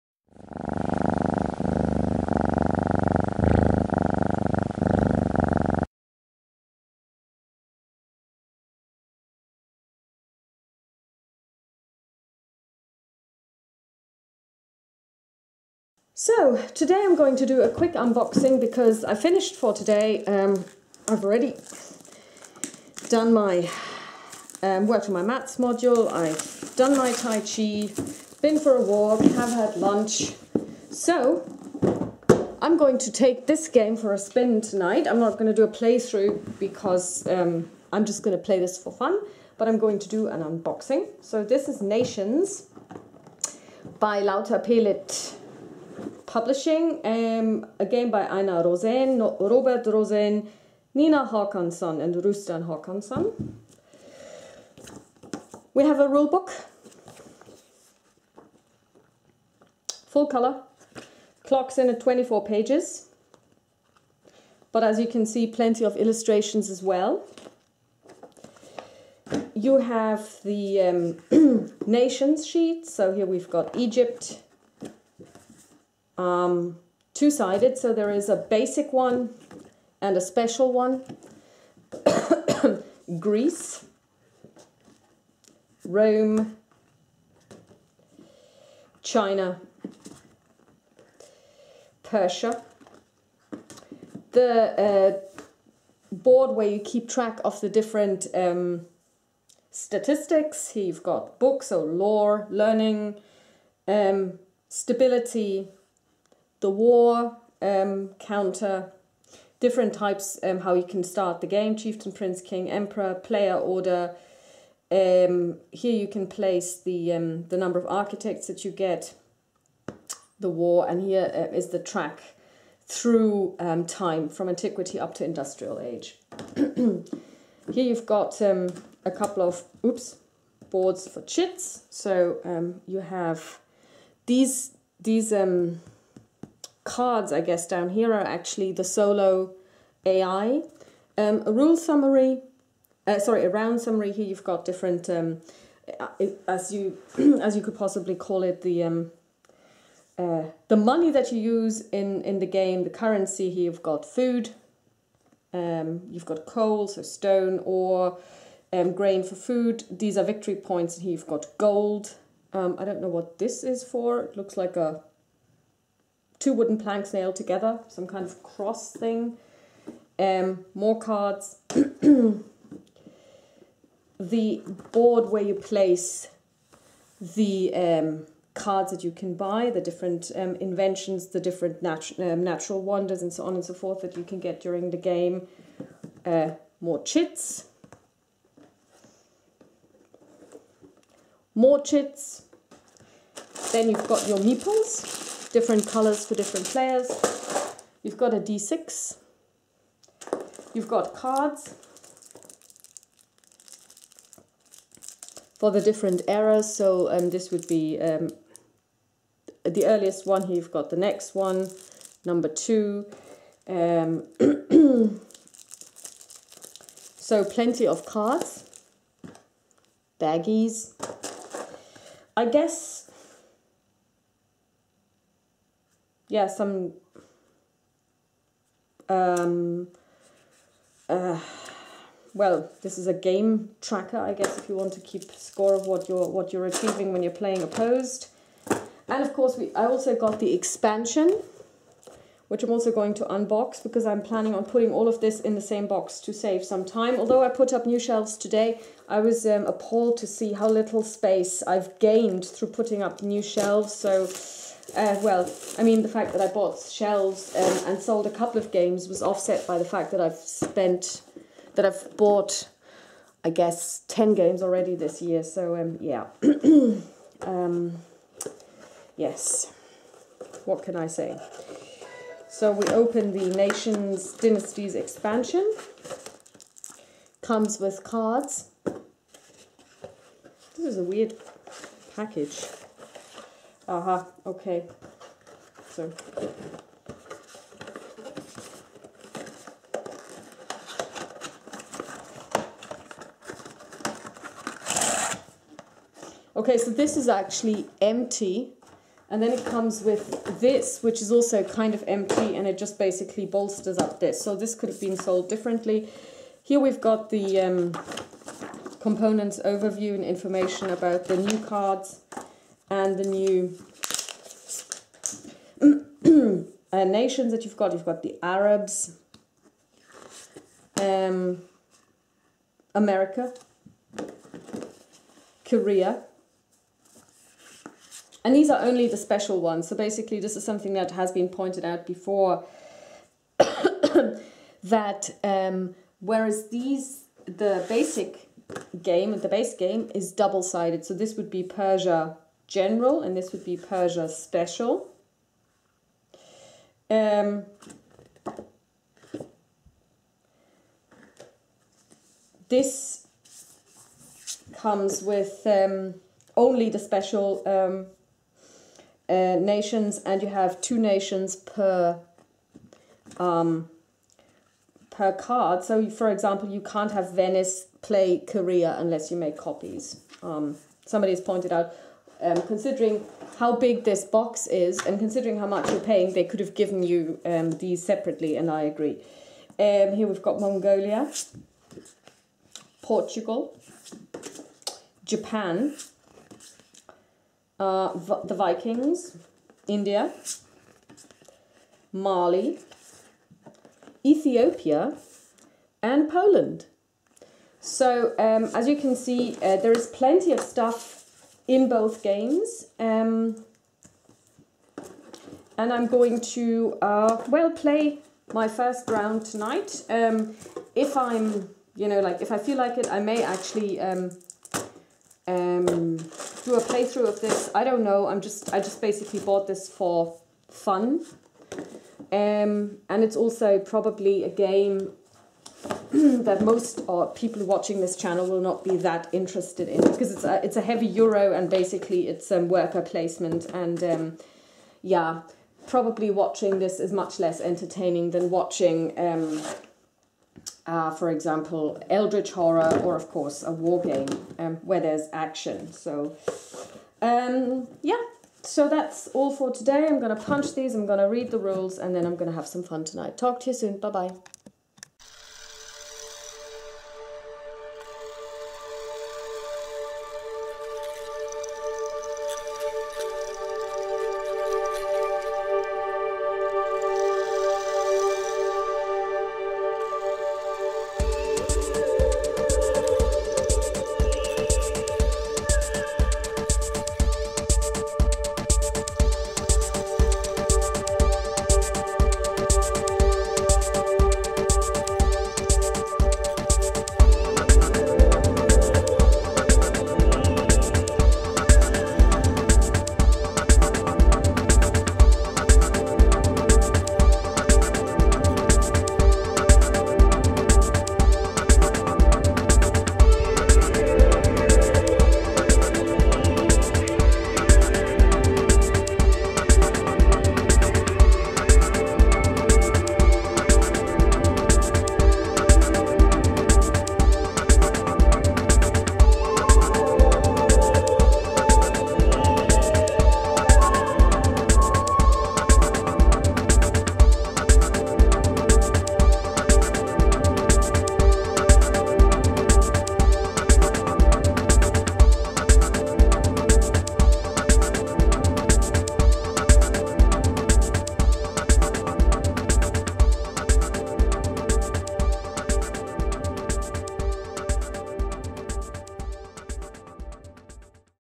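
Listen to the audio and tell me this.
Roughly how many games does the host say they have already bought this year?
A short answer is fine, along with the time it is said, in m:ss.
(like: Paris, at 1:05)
10, at 4:24.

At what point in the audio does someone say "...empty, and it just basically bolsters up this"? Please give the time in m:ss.
5:02.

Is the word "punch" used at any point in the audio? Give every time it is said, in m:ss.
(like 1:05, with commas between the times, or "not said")
7:30.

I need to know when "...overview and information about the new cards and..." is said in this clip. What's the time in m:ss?
5:09.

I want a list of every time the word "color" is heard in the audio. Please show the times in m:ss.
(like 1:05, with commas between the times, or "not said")
1:00, 3:15.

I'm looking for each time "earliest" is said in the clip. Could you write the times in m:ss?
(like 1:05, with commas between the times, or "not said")
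3:29.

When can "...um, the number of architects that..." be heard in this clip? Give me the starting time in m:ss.
1:57.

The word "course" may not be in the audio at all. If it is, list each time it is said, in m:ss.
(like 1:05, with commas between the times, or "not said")
3:59, 7:23.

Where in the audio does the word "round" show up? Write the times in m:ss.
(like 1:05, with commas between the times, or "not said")
2:23, 6:49.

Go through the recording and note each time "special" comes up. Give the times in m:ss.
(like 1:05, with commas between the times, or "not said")
1:20, 5:29, 5:44, 5:56.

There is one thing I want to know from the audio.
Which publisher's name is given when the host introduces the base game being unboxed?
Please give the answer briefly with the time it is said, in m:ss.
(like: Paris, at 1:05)
Lautapelit, at 0:44.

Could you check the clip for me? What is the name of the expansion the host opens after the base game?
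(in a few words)
Dynasties.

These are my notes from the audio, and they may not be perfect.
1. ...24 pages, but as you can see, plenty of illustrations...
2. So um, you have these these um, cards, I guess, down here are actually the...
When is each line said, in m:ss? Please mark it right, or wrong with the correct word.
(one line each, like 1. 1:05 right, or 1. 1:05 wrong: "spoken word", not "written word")
1. 1:01 right
2. 2:11 right.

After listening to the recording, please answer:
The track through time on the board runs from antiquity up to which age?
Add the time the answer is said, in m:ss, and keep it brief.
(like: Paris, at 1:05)
Industrial age, at 2:05.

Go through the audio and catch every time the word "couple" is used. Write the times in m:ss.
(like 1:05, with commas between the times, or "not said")
2:09, 4:18.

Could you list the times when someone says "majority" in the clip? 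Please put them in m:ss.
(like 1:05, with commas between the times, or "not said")
not said.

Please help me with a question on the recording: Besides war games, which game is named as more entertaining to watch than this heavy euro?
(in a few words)
Eldritch Horror.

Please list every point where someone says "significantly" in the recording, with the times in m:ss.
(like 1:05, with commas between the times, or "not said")
not said.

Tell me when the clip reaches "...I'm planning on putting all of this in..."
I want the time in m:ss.
4:04.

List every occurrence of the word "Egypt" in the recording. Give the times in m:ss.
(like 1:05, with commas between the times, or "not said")
1:13.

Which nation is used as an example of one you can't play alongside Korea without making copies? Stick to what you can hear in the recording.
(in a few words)
Venice.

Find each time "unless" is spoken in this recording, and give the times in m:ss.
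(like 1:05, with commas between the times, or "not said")
6:08.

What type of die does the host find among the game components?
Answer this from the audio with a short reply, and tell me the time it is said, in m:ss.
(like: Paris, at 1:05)
D6, at 3:18.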